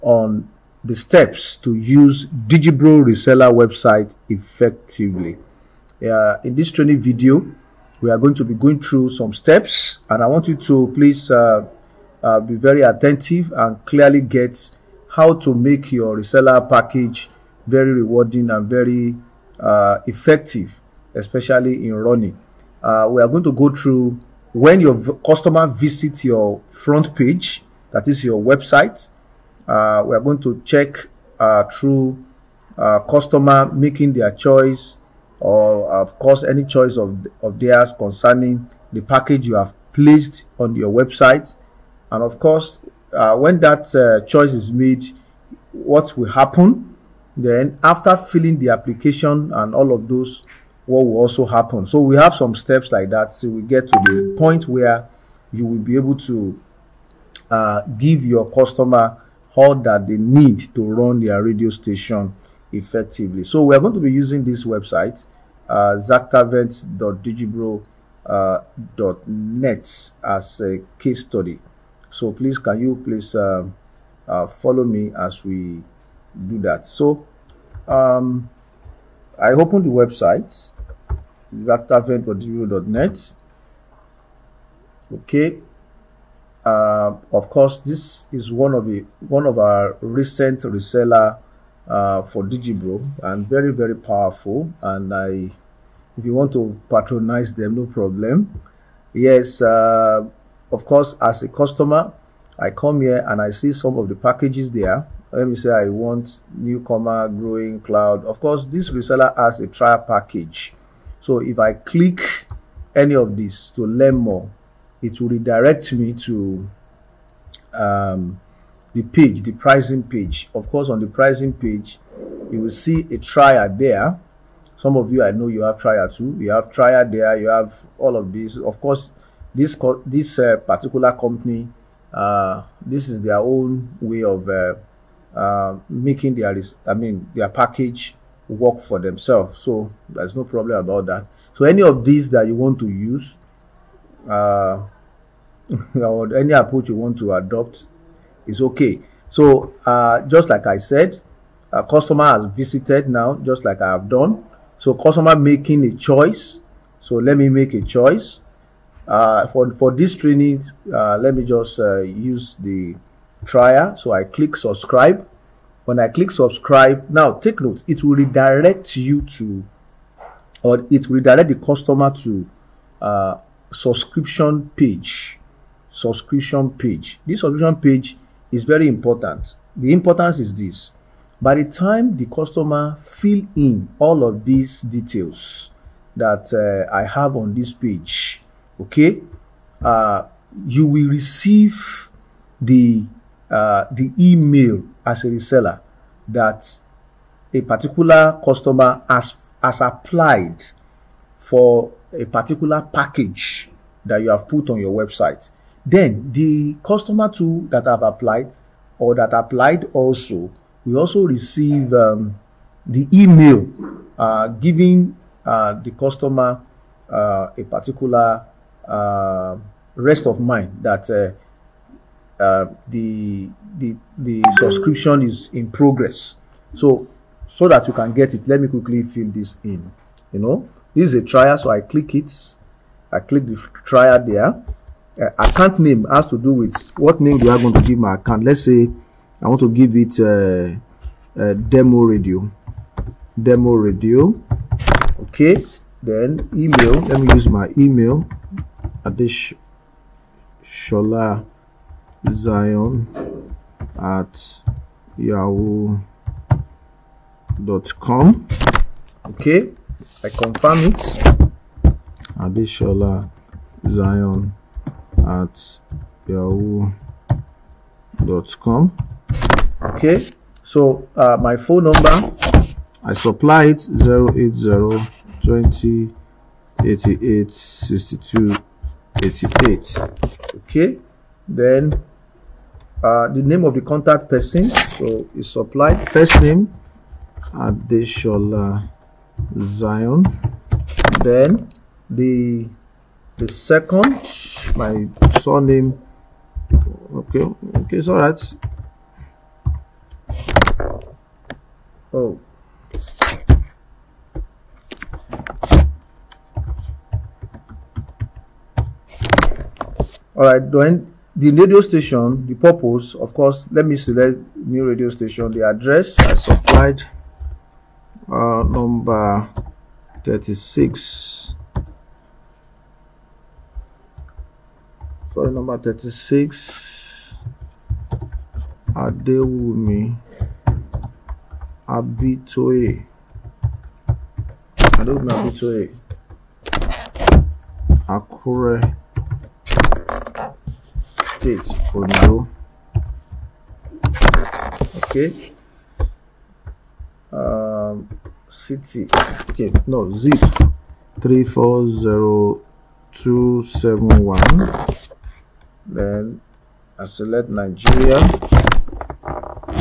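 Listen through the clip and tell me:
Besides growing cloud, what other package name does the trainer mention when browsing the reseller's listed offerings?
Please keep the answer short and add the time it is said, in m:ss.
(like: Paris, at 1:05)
Newcomer, at 1:46.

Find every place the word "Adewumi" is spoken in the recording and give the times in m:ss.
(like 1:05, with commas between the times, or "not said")
5:28, 5:34.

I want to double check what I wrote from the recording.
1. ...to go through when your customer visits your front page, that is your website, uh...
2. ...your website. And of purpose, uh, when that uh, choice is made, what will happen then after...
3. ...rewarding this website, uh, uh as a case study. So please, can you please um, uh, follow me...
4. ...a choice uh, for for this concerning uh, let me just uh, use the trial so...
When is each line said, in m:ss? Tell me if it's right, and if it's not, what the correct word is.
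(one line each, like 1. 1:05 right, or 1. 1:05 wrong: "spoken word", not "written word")
1. 0:23 right
2. 0:40 wrong: "course", not "purpose"
3. 1:04 wrong: "using", not "rewarding"
4. 2:37 wrong: "training", not "concerning".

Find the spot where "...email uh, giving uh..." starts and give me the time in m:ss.
3:33.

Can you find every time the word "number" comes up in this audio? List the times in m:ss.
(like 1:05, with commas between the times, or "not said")
4:31, 5:18, 5:25.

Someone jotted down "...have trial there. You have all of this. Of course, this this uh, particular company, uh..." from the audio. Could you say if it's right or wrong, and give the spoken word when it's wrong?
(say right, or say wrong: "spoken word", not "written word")
right.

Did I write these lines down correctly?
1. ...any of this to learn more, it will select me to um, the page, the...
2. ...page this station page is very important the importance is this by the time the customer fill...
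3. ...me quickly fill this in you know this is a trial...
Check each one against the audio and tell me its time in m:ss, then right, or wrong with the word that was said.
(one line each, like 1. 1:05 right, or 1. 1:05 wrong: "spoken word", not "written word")
1. 1:52 wrong: "redirect", not "select"
2. 2:56 wrong: "subscription", not "station"
3. 3:48 right.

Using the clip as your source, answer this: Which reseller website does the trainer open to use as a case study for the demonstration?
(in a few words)
xactavent.net.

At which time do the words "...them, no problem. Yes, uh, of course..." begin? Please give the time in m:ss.
1:37.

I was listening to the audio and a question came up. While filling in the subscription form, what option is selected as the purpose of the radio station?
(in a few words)
New radio station.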